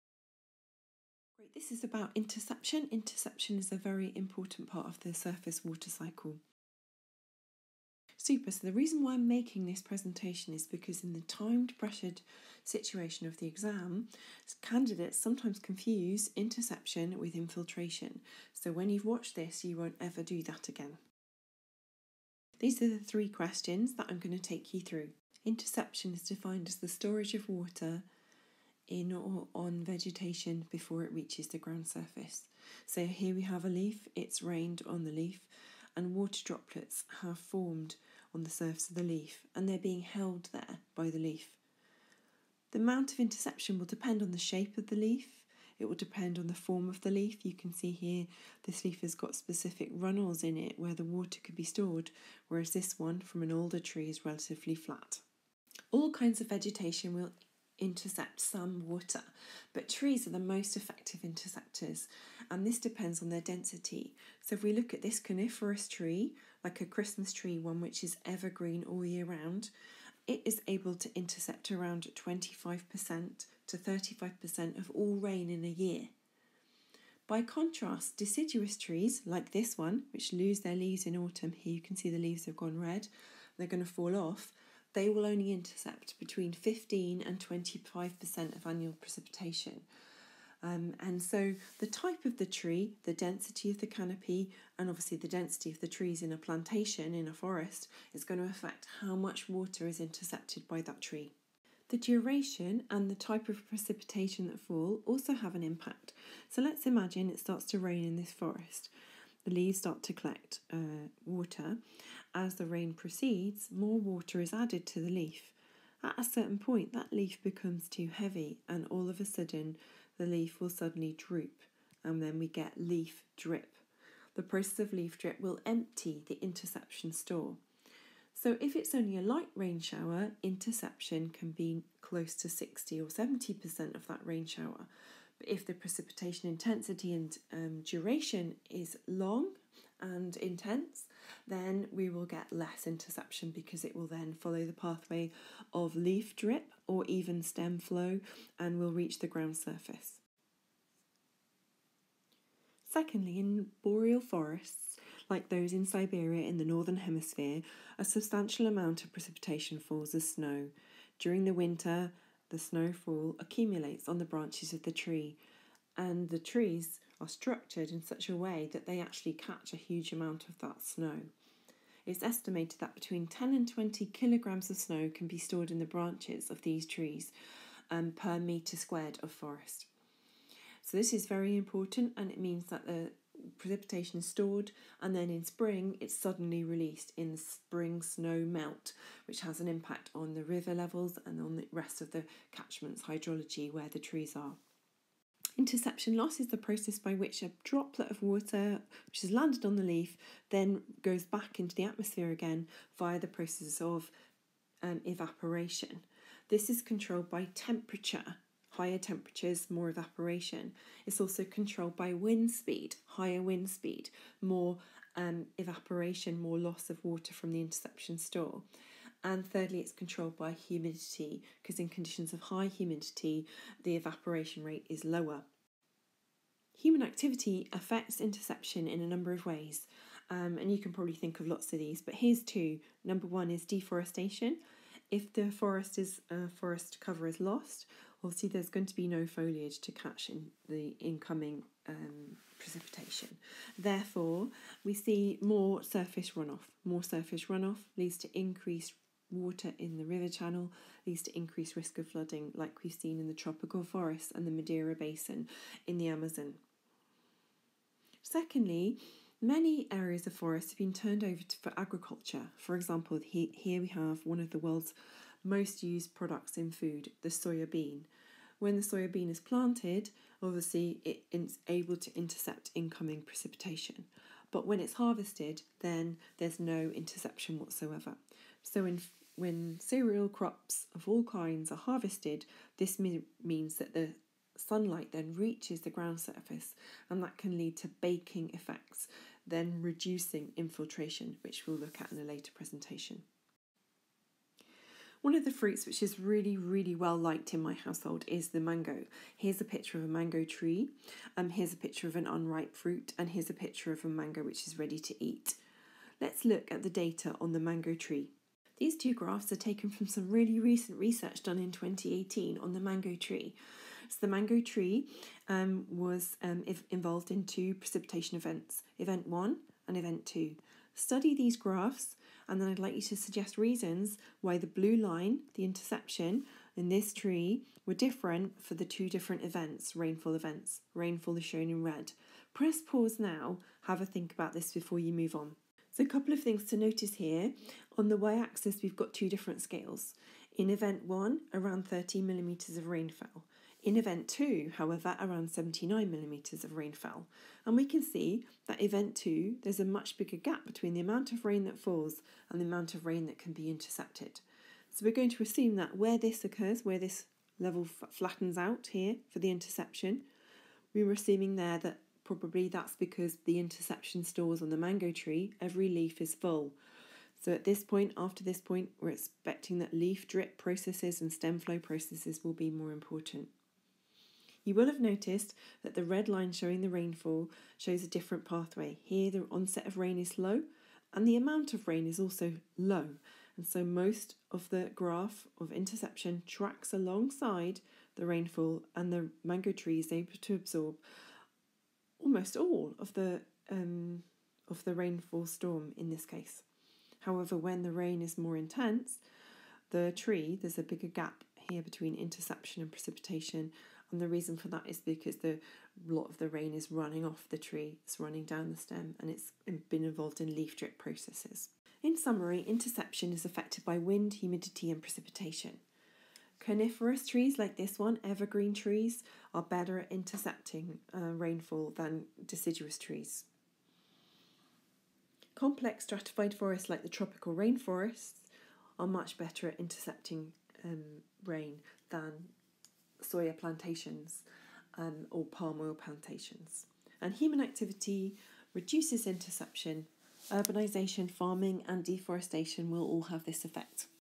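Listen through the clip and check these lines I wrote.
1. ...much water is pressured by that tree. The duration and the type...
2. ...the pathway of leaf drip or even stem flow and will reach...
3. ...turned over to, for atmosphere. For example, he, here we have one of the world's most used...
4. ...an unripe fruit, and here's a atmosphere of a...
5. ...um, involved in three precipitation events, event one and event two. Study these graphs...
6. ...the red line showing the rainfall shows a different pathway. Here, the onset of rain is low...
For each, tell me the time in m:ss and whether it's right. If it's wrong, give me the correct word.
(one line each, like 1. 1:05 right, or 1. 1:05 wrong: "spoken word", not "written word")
1. 1:39 wrong: "intercepted", not "pressured"
2. 2:24 right
3. 4:20 wrong: "agriculture", not "atmosphere"
4. 5:02 wrong: "picture", not "atmosphere"
5. 5:16 wrong: "two", not "three"
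6. 6:15 right.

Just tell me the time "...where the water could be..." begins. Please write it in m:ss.
0:50.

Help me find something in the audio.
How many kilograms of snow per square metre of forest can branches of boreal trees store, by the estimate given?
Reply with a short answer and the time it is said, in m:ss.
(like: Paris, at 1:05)
10 to 20 kilograms, at 2:52.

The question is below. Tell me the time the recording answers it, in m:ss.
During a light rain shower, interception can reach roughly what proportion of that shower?
2:12.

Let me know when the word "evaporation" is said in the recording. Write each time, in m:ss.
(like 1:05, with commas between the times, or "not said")
3:25, 3:29, 3:35, 3:43.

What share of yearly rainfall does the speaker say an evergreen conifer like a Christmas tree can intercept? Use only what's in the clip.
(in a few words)
25% to 35%.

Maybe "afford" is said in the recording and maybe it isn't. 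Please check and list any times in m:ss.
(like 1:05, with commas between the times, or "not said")
not said.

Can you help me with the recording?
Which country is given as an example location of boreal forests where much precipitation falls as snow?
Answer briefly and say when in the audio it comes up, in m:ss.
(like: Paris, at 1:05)
Siberia, at 2:35.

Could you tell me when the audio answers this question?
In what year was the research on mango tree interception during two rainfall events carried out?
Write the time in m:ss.
5:11.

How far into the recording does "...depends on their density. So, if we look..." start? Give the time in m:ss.
1:02.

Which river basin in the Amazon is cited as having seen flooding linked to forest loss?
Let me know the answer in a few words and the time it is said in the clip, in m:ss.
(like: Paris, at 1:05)
Madeira Basin, at 4:14.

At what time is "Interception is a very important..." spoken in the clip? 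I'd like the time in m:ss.
0:02.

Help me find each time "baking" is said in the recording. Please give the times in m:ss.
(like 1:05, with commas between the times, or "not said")
4:47.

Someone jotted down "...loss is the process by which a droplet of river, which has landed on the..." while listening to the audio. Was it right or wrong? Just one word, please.
wrong.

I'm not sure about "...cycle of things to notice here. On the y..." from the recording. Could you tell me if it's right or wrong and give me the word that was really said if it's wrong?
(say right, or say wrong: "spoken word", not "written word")
wrong: "couple", not "cycle".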